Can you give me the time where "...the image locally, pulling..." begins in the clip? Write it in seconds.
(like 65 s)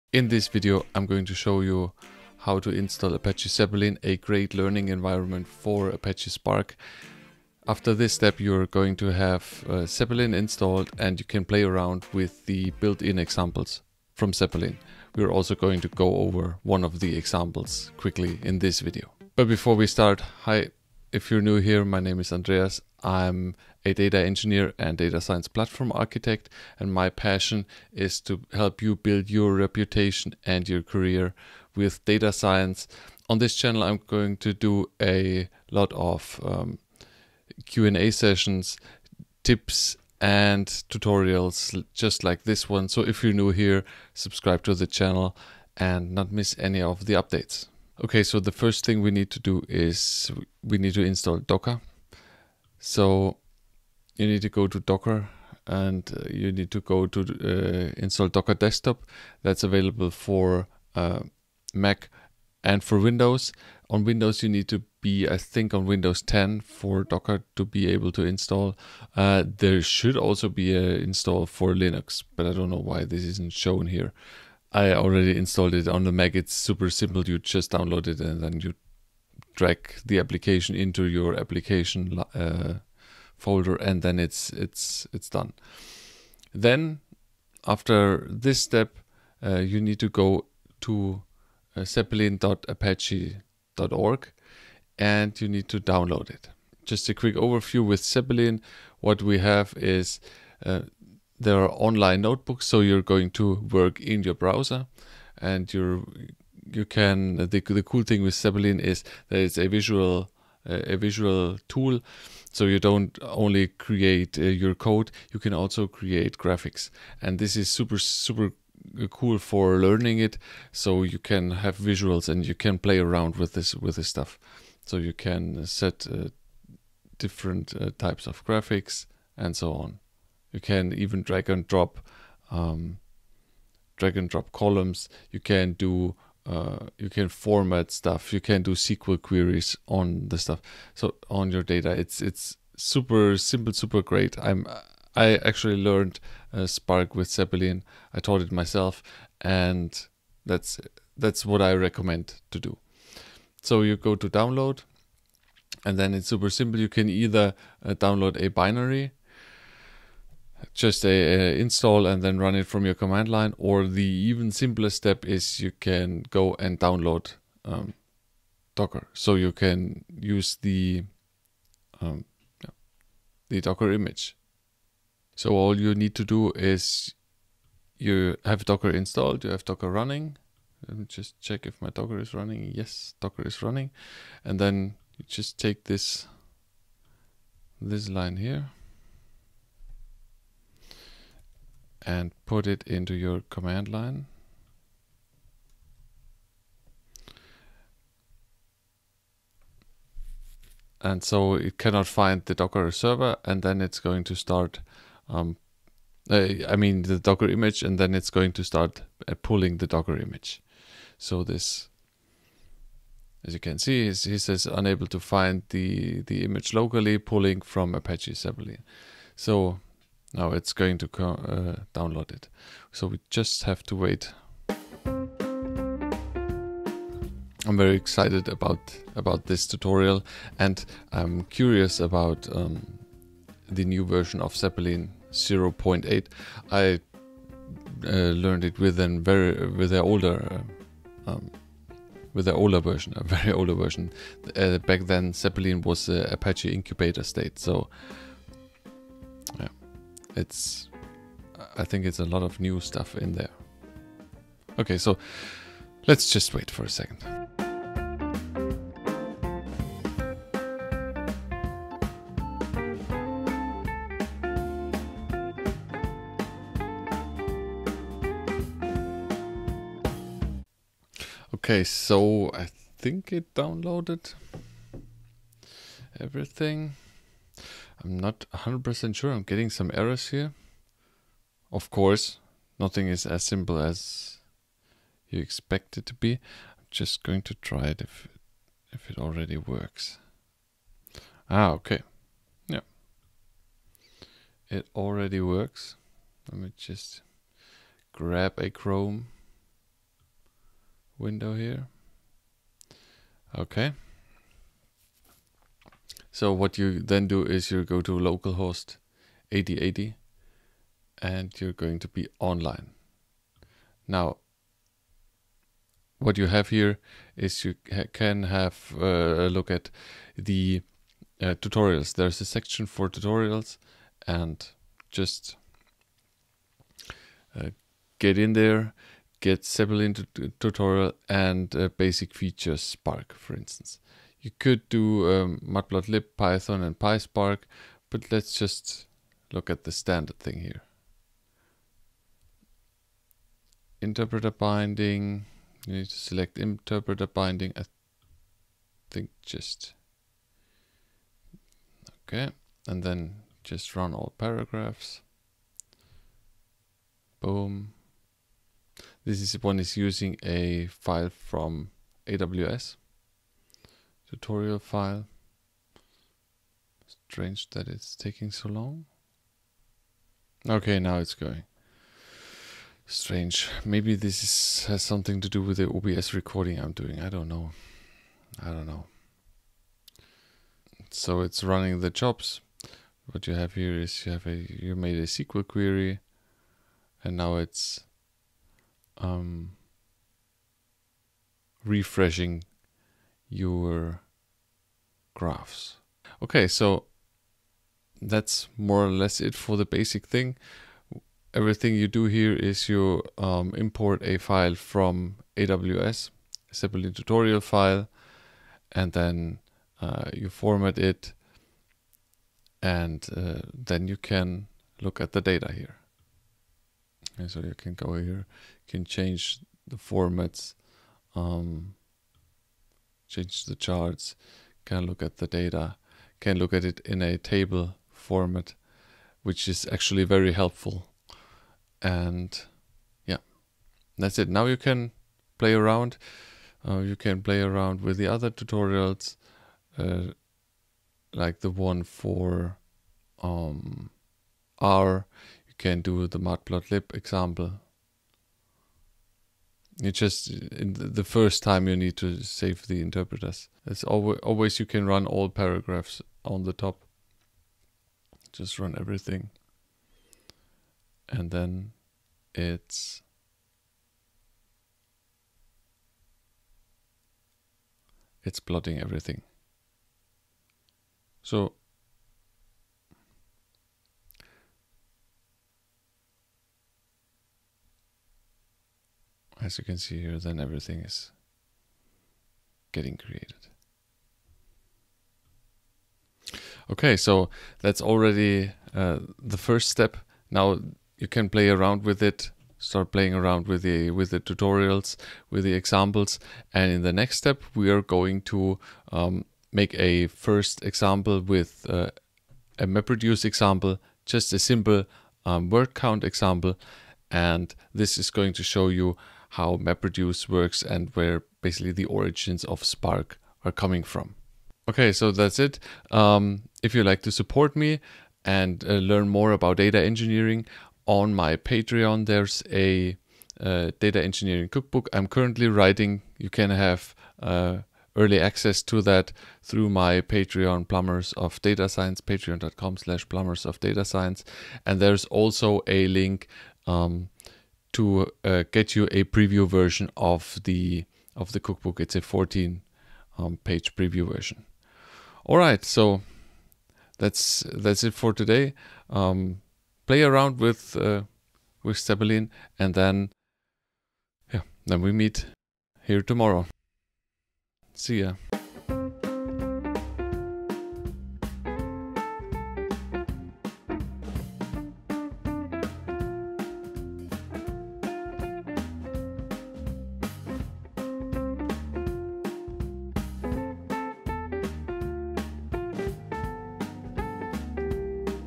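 216 s.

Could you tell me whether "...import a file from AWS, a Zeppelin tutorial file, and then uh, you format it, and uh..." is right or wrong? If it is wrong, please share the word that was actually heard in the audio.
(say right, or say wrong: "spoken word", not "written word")
right.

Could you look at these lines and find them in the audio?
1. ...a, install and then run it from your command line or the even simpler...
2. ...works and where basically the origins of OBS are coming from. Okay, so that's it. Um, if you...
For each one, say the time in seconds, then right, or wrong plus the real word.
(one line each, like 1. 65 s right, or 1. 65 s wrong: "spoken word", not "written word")
1. 161 s right
2. 510 s wrong: "Spark", not "OBS".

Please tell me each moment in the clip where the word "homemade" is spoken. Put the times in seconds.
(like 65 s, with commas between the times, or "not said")
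not said.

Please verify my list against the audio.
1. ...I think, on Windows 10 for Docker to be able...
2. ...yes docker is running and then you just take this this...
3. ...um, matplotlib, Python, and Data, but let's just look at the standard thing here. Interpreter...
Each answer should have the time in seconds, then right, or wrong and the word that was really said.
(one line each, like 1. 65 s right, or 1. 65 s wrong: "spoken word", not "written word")
1. 65 s right
2. 182 s right
3. 335 s wrong: "PySpark", not "Data".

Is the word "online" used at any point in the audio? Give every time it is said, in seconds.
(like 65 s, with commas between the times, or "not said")
101 s, 312 s.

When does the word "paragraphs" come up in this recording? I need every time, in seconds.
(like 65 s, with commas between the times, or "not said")
354 s, 455 s.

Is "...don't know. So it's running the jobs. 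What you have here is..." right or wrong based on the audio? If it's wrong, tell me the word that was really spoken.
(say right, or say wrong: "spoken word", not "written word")
right.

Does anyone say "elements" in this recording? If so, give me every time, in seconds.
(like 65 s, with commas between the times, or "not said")
not said.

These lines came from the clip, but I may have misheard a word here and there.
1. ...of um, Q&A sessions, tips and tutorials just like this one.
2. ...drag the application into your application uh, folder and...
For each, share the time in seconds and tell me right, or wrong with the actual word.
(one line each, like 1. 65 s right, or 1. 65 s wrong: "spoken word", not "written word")
1. 35 s right
2. 79 s right.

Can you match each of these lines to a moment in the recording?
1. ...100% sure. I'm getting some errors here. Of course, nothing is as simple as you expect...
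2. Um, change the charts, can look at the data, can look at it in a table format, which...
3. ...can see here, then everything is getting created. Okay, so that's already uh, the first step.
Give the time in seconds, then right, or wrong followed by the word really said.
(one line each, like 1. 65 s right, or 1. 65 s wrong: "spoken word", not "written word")
1. 278 s right
2. 421 s right
3. 479 s right.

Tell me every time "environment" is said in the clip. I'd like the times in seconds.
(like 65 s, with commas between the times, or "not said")
4 s.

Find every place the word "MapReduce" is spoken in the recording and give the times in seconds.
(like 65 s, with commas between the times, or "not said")
502 s, 509 s.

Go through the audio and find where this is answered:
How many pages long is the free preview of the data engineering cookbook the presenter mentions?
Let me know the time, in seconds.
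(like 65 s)
542 s.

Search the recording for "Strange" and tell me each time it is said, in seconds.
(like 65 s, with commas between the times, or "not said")
367 s, 373 s.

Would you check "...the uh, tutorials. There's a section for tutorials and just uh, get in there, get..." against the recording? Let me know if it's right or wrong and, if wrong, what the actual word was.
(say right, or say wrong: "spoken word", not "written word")
right.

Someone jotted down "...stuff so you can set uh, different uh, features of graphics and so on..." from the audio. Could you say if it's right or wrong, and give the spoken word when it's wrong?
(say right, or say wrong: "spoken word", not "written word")
wrong: "types", not "features".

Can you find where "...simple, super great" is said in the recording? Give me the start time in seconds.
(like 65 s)
143 s.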